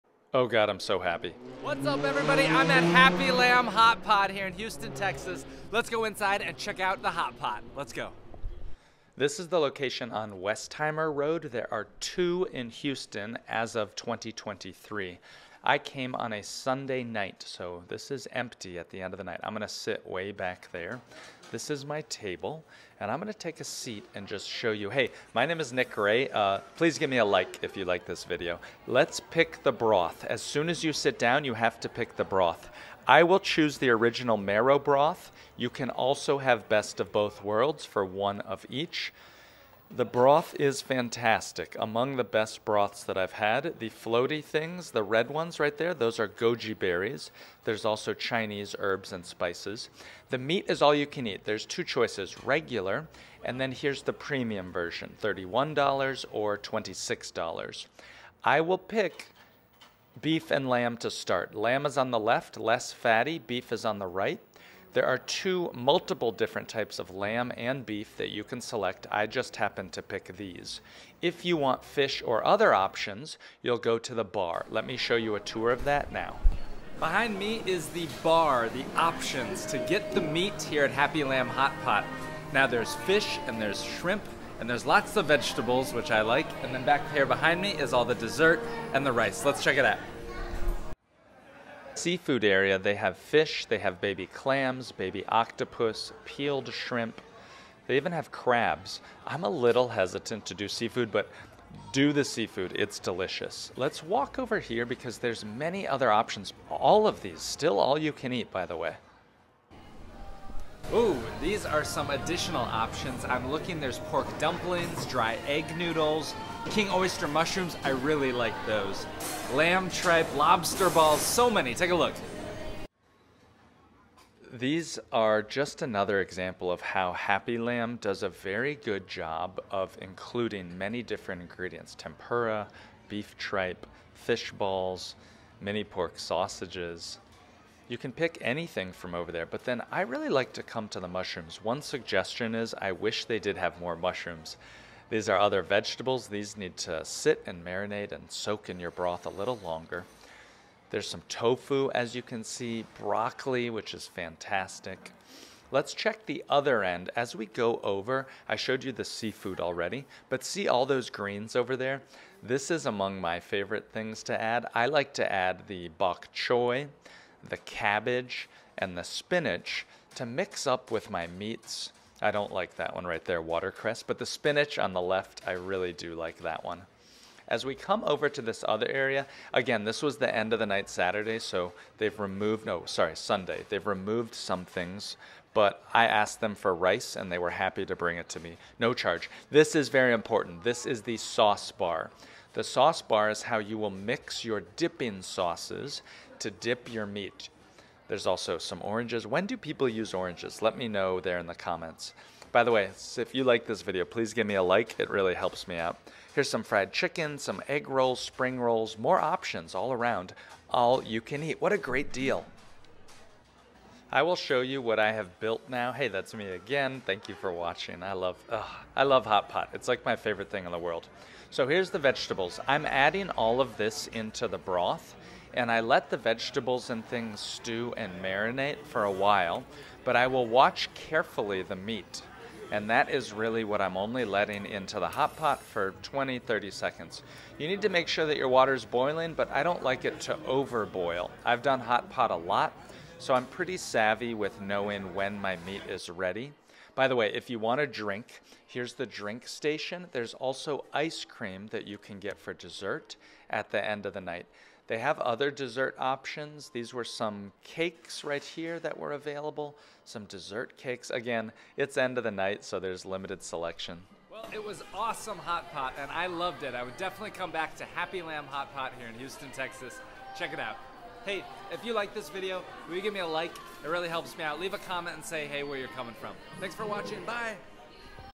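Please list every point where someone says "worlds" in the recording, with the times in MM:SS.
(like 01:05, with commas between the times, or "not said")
00:37, 03:40.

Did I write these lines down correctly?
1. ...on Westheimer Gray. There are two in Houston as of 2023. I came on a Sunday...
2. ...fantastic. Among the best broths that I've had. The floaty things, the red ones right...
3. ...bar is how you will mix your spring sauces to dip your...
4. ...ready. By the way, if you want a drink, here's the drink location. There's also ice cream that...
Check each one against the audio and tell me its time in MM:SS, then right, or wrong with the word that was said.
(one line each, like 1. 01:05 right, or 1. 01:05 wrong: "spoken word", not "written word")
1. 00:10 wrong: "Road", not "Gray"
2. 00:40 right
3. 03:13 wrong: "dipping", not "spring"
4. 04:06 wrong: "station", not "location".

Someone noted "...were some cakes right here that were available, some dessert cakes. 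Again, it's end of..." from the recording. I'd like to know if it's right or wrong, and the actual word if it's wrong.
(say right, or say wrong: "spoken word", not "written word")
right.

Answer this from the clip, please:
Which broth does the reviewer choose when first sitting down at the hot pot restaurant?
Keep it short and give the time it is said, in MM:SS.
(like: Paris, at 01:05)
Original marrow broth, at 00:33.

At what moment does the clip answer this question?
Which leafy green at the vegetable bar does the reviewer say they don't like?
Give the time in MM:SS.
02:53.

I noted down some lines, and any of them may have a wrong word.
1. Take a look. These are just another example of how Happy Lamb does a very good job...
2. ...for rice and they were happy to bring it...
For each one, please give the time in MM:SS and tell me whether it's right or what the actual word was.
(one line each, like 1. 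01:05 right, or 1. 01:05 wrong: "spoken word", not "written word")
1. 02:01 right
2. 03:06 right.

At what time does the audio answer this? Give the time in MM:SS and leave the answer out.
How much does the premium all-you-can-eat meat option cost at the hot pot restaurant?
00:55.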